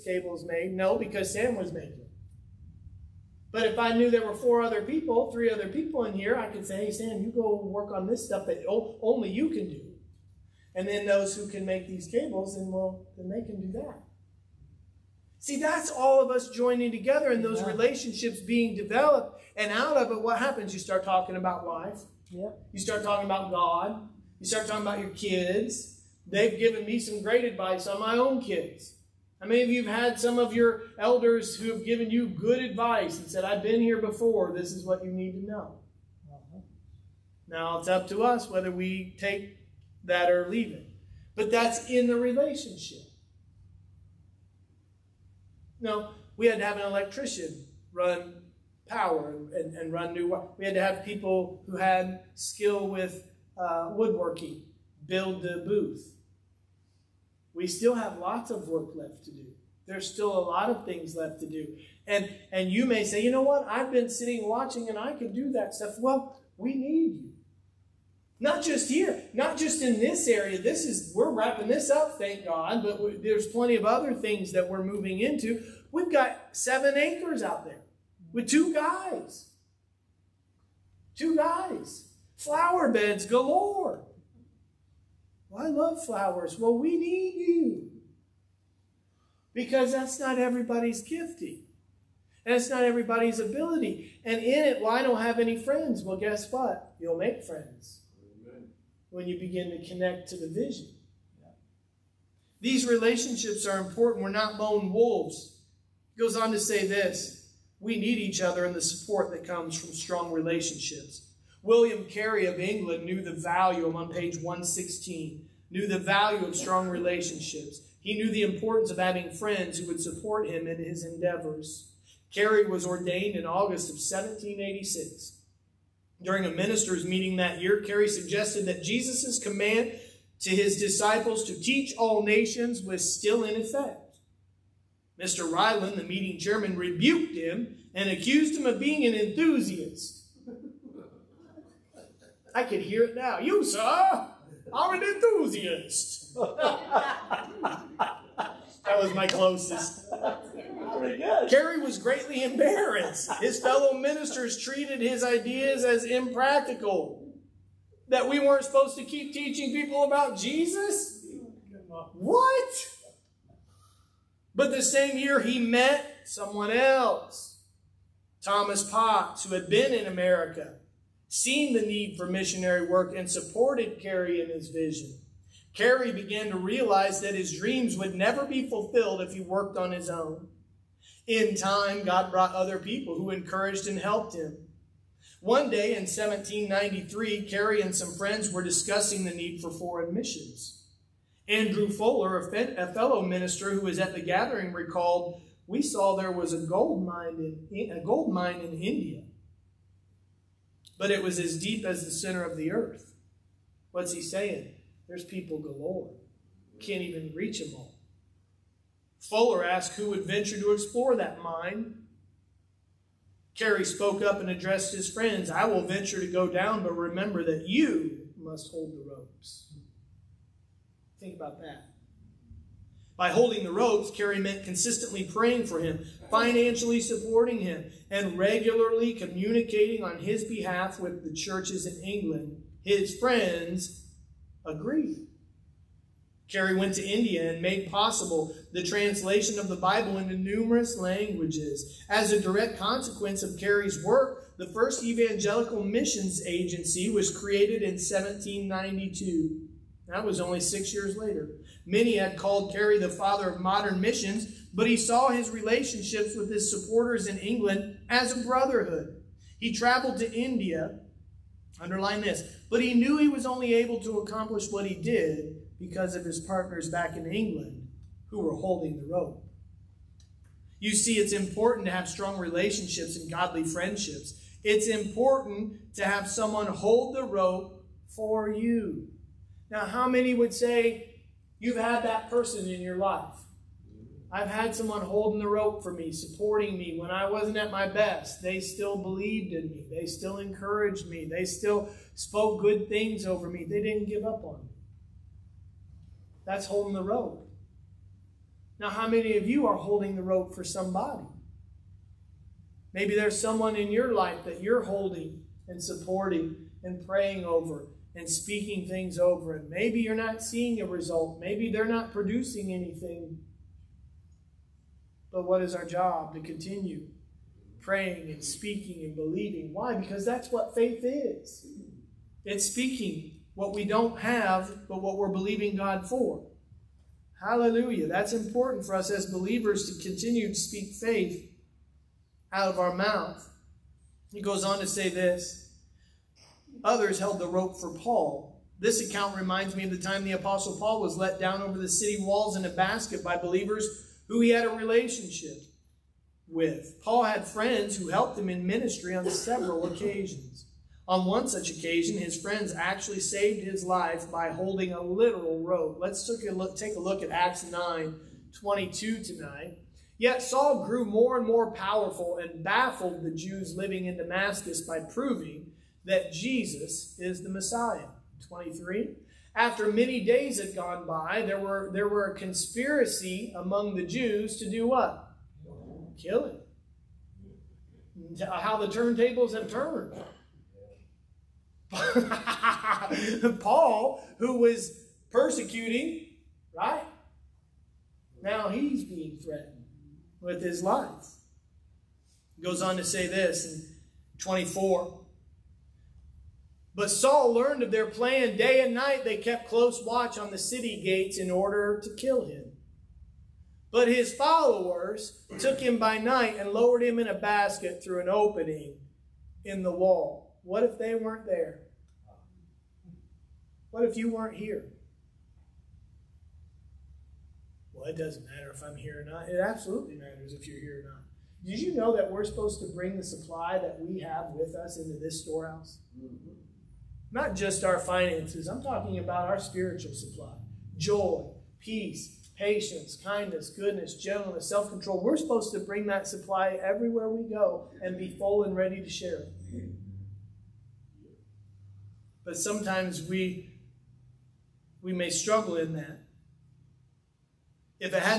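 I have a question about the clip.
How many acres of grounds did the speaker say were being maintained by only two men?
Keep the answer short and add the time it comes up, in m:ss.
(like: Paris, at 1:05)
7, at 1:16.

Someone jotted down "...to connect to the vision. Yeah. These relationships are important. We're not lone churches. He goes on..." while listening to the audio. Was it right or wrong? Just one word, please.
wrong.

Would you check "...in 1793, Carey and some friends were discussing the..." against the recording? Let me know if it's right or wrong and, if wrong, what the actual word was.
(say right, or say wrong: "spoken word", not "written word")
right.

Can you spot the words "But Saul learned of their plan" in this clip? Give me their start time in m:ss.
6:36.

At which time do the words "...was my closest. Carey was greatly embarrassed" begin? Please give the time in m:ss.
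2:29.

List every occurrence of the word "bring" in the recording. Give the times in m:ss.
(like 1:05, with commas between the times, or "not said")
7:02, 7:15.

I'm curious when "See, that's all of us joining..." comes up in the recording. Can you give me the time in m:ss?
0:15.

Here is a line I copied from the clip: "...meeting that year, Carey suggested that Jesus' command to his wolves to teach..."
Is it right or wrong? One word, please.
wrong.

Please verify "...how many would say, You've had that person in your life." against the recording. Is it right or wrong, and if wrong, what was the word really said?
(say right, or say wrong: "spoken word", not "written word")
right.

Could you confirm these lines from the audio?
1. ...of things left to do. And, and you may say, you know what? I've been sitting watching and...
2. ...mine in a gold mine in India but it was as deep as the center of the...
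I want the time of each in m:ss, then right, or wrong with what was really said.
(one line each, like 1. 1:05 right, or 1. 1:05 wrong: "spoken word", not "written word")
1. 1:00 right
2. 3:17 right.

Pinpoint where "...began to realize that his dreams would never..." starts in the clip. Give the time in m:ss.
2:56.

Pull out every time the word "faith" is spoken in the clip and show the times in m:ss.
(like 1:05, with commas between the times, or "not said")
5:20, 5:30.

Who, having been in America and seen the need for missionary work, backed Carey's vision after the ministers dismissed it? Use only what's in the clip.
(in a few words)
Thomas Potts.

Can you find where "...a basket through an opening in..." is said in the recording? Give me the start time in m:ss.
6:47.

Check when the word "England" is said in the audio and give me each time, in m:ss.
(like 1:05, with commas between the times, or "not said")
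1:52, 3:52, 4:17, 4:27.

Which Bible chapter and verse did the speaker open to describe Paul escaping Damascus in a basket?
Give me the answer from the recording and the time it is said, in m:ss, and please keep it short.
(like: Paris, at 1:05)
Acts 9:22, at 5:57.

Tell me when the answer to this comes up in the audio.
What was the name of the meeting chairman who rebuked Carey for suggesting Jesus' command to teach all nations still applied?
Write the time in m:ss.
2:15.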